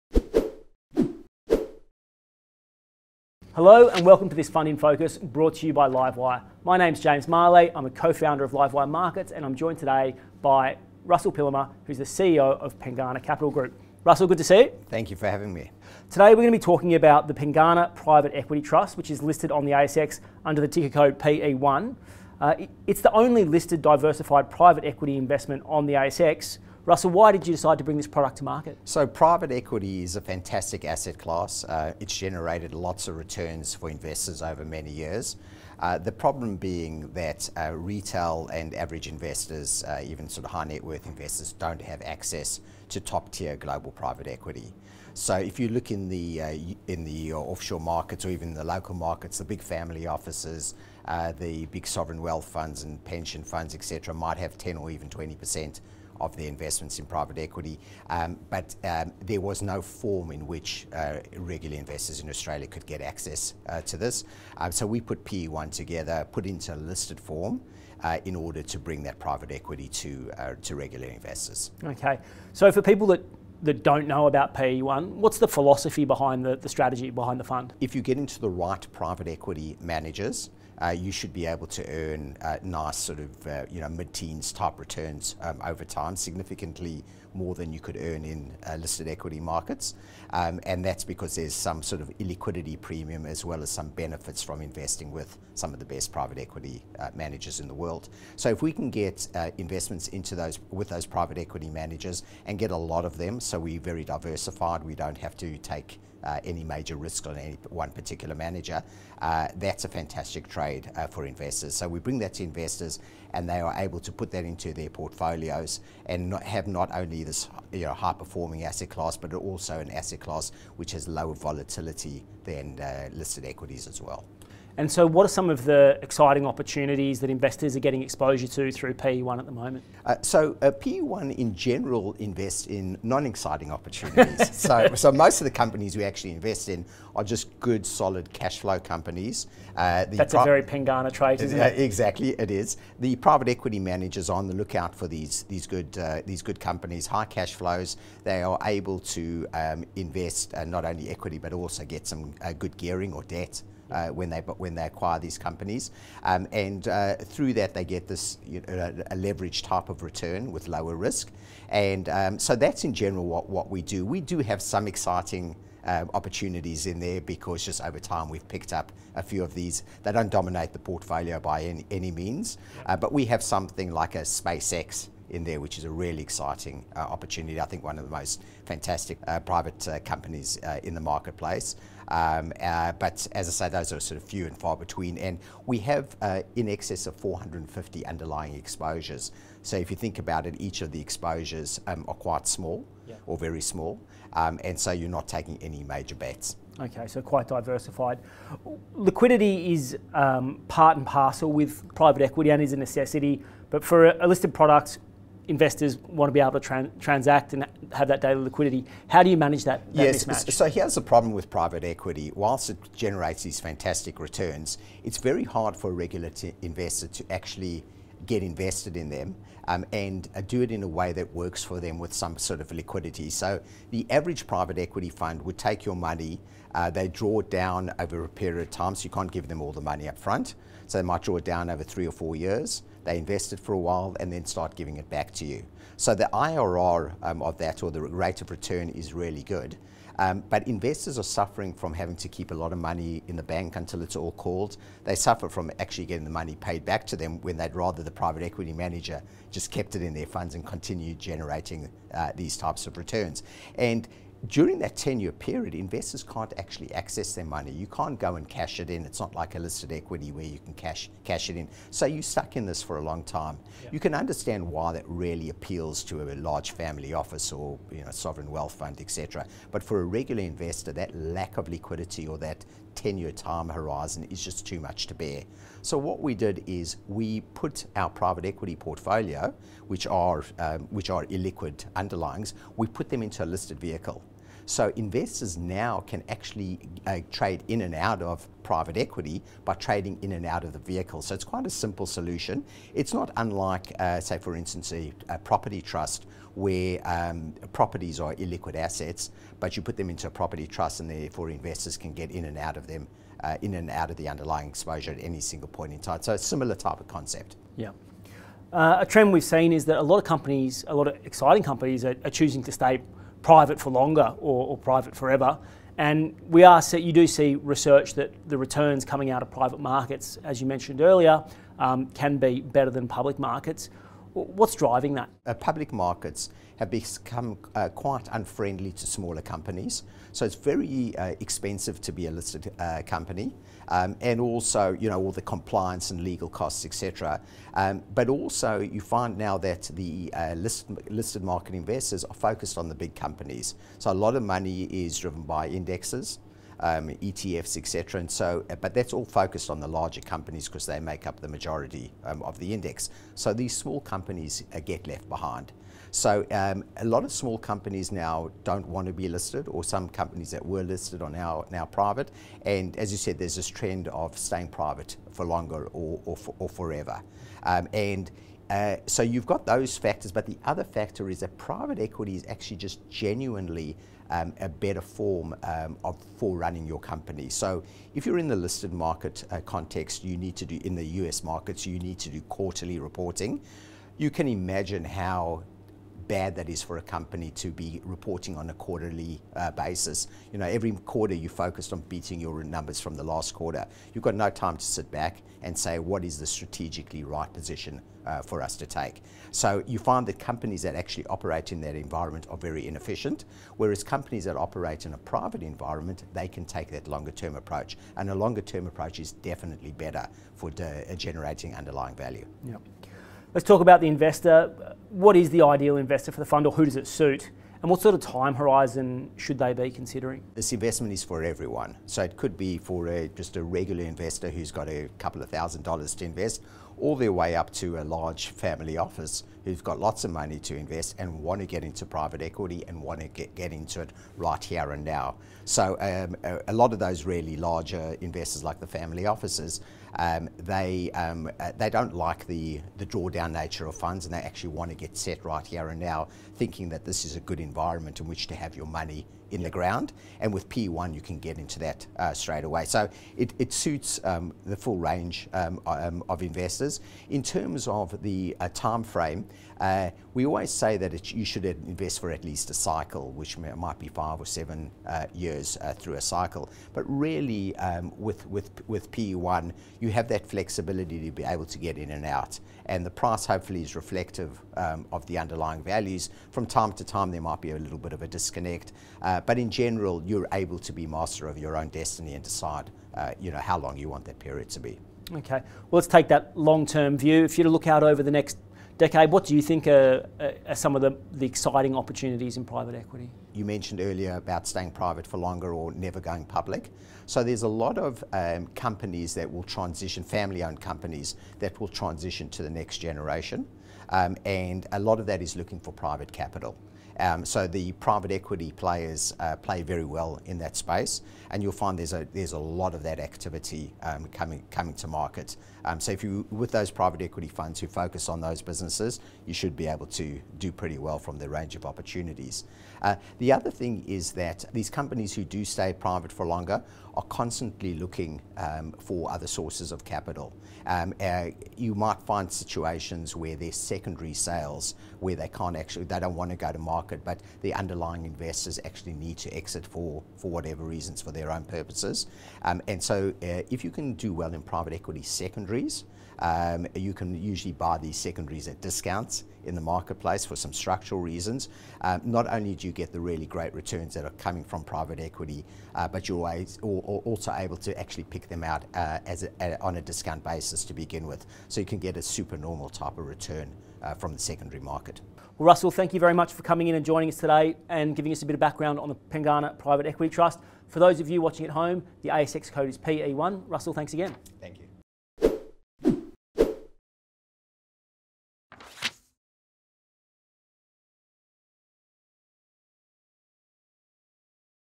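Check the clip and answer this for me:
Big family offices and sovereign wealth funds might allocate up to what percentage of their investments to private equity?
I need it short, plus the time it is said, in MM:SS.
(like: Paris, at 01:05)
20 percent, at 00:55.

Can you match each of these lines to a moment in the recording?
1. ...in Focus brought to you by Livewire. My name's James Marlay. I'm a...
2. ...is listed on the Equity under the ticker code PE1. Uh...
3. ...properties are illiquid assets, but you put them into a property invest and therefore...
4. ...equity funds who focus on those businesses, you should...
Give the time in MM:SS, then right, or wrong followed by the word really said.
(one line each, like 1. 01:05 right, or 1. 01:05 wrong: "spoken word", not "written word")
1. 00:04 right
2. 00:19 wrong: "ASX", not "Equity"
3. 04:57 wrong: "trust", not "invest"
4. 08:37 right.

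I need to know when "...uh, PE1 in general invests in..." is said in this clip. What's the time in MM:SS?
02:10.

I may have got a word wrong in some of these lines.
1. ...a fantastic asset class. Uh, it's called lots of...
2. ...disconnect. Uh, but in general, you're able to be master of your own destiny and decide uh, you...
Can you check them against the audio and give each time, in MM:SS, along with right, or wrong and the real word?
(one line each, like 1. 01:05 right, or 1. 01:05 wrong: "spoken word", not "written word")
1. 00:30 wrong: "generated", not "called"
2. 07:58 right.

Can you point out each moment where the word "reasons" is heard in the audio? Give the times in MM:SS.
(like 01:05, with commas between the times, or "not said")
09:00, 09:11.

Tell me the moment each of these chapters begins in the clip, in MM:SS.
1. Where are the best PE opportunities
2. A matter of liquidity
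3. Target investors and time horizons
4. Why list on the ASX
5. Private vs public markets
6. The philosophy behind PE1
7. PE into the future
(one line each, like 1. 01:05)
1. 02:04
2. 03:17
3. 06:53
4. 00:16
5. 05:07
6. 01:12
7. 08:05.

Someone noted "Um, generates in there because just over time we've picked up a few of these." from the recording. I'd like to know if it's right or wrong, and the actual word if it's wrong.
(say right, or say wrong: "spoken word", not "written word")
wrong: "opportunities", not "generates".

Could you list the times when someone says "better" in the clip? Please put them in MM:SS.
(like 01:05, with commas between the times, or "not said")
05:22, 06:14, 06:49.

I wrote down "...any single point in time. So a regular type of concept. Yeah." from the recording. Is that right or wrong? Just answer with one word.
wrong.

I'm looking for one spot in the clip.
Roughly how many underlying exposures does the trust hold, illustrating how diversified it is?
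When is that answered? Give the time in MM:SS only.
03:07.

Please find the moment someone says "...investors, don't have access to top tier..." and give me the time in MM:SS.
00:41.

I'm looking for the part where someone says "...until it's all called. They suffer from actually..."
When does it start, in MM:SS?
04:03.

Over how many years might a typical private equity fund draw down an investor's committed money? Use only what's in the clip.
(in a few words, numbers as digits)
three or four years.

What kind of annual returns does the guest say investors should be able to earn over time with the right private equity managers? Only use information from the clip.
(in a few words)
mid-teens.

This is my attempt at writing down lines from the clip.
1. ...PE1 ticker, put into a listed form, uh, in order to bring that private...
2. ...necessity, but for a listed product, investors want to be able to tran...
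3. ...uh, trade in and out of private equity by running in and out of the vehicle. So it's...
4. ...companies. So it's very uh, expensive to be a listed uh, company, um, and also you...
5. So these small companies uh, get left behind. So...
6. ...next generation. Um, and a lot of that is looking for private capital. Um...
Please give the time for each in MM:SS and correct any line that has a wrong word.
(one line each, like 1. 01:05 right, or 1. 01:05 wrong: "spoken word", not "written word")
1. 01:05 wrong: "together", not "ticker"
2. 03:22 right
3. 04:47 wrong: "trading", not "running"
4. 05:29 right
5. 05:53 right
6. 08:22 right.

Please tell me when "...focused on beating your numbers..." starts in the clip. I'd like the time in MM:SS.
06:31.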